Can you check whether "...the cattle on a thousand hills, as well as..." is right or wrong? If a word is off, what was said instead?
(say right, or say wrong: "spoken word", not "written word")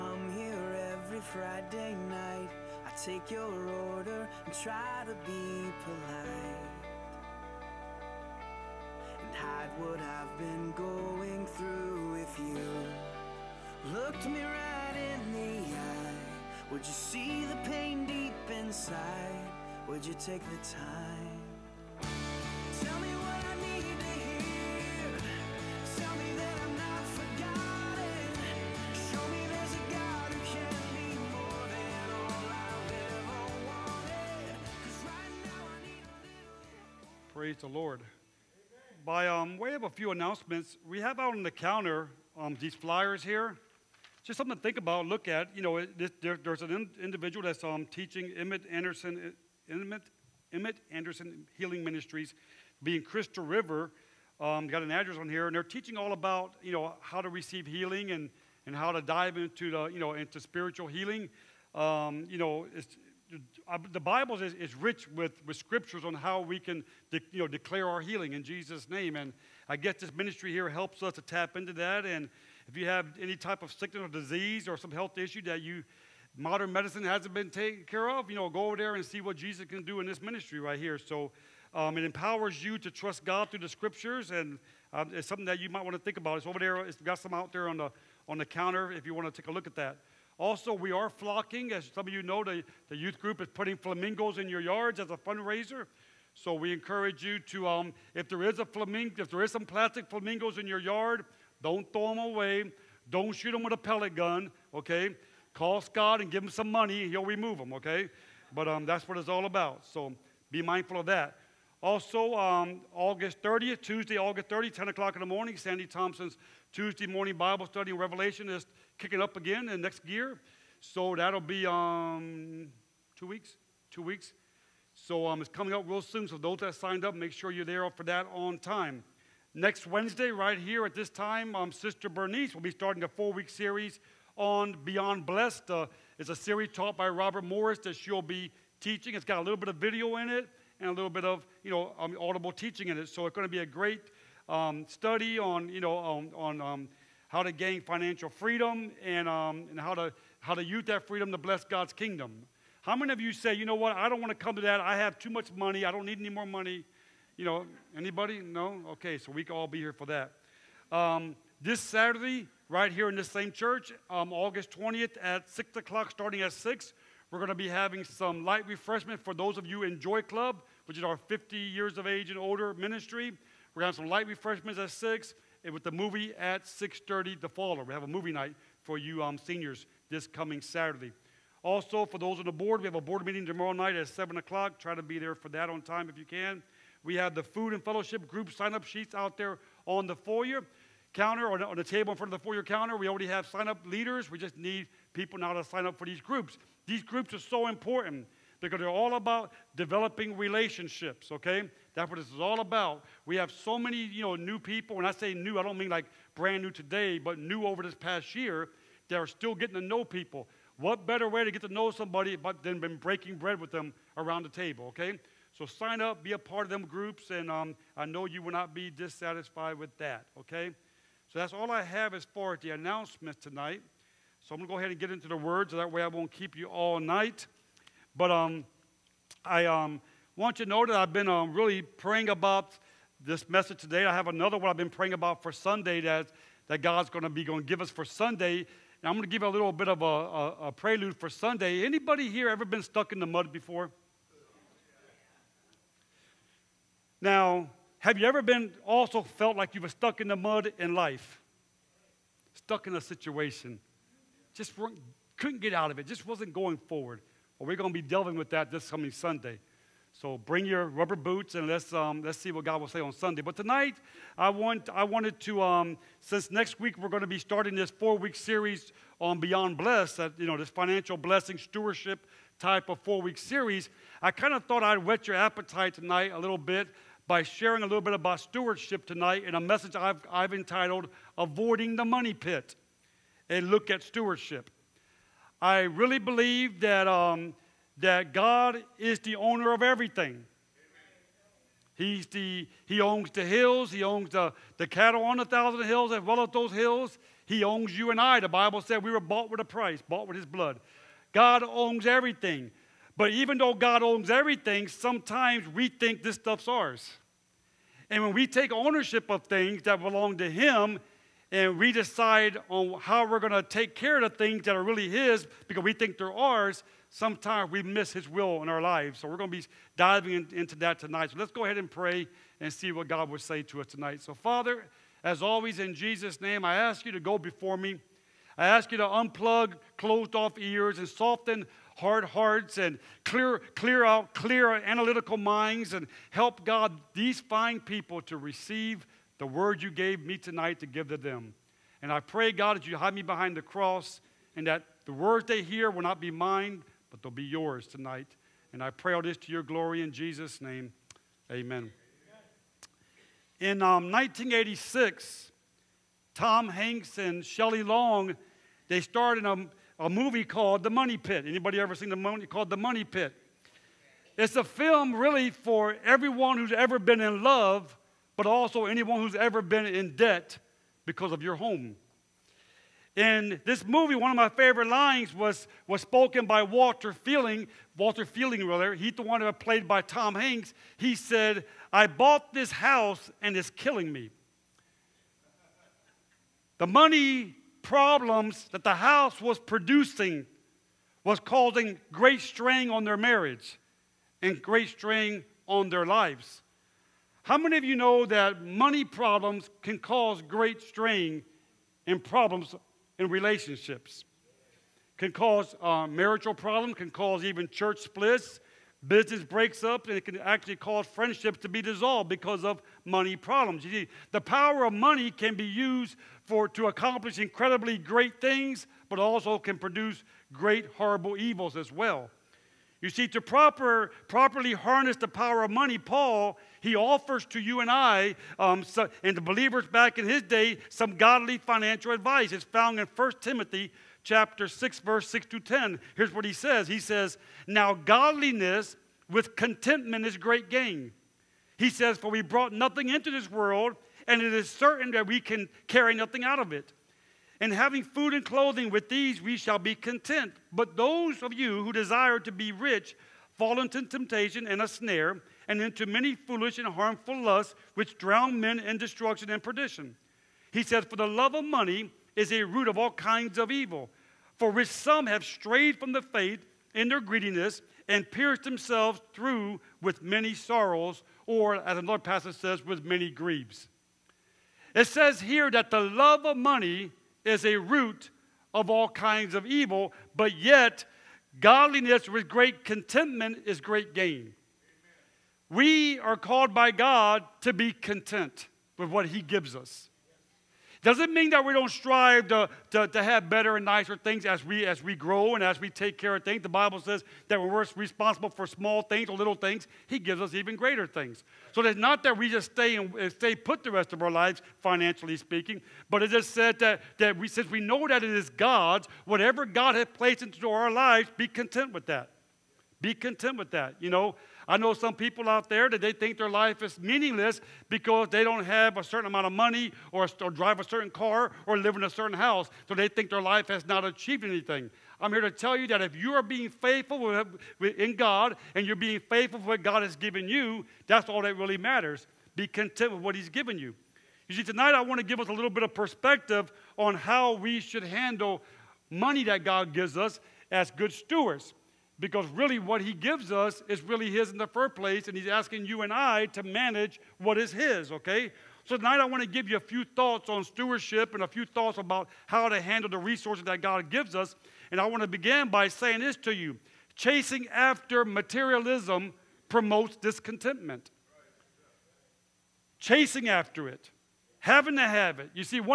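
right.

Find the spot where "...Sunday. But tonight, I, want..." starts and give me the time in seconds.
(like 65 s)
263 s.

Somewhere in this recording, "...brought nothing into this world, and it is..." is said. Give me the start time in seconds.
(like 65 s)
442 s.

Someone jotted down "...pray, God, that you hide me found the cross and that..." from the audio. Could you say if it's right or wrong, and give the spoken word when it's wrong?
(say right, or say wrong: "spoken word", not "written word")
wrong: "behind", not "found".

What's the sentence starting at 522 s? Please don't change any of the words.
So they think their life has not achieved anything.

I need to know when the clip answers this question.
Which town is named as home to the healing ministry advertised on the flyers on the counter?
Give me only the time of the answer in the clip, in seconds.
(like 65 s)
53 s.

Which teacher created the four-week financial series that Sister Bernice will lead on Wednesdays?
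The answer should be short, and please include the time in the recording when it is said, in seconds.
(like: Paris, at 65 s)
Robert Morris, at 137 s.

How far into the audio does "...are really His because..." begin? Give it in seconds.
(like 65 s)
314 s.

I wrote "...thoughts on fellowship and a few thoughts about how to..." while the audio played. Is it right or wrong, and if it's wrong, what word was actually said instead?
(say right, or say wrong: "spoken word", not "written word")
wrong: "stewardship", not "fellowship".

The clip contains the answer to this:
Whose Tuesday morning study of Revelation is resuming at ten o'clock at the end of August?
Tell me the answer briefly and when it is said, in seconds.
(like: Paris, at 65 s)
Sandy Thompson, at 115 s.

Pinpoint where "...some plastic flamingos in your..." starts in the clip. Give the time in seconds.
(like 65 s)
99 s.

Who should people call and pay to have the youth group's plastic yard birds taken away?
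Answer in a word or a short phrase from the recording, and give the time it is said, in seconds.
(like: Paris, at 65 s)
Scott, at 105 s.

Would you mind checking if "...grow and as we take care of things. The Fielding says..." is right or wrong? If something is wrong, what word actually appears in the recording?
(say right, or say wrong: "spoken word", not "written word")
wrong: "Bible", not "Fielding".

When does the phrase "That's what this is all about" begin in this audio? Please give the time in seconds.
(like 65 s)
201 s.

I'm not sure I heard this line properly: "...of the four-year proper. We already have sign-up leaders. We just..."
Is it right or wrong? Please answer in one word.
wrong.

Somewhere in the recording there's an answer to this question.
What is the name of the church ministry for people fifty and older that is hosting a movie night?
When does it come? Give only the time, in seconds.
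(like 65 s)
169 s.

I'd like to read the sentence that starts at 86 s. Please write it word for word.
It's over there, it's got some out there on the, on the counter if you want to take a look at that.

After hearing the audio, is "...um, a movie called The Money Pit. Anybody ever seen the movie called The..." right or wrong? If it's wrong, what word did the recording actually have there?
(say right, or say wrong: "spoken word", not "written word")
right.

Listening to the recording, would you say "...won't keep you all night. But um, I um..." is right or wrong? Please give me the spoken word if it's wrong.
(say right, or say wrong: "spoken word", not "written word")
right.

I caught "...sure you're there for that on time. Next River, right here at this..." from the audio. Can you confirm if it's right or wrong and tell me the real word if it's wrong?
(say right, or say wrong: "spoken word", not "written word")
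wrong: "Wednesday", not "River".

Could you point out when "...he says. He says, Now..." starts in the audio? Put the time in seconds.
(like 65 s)
436 s.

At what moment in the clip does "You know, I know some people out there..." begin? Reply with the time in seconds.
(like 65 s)
513 s.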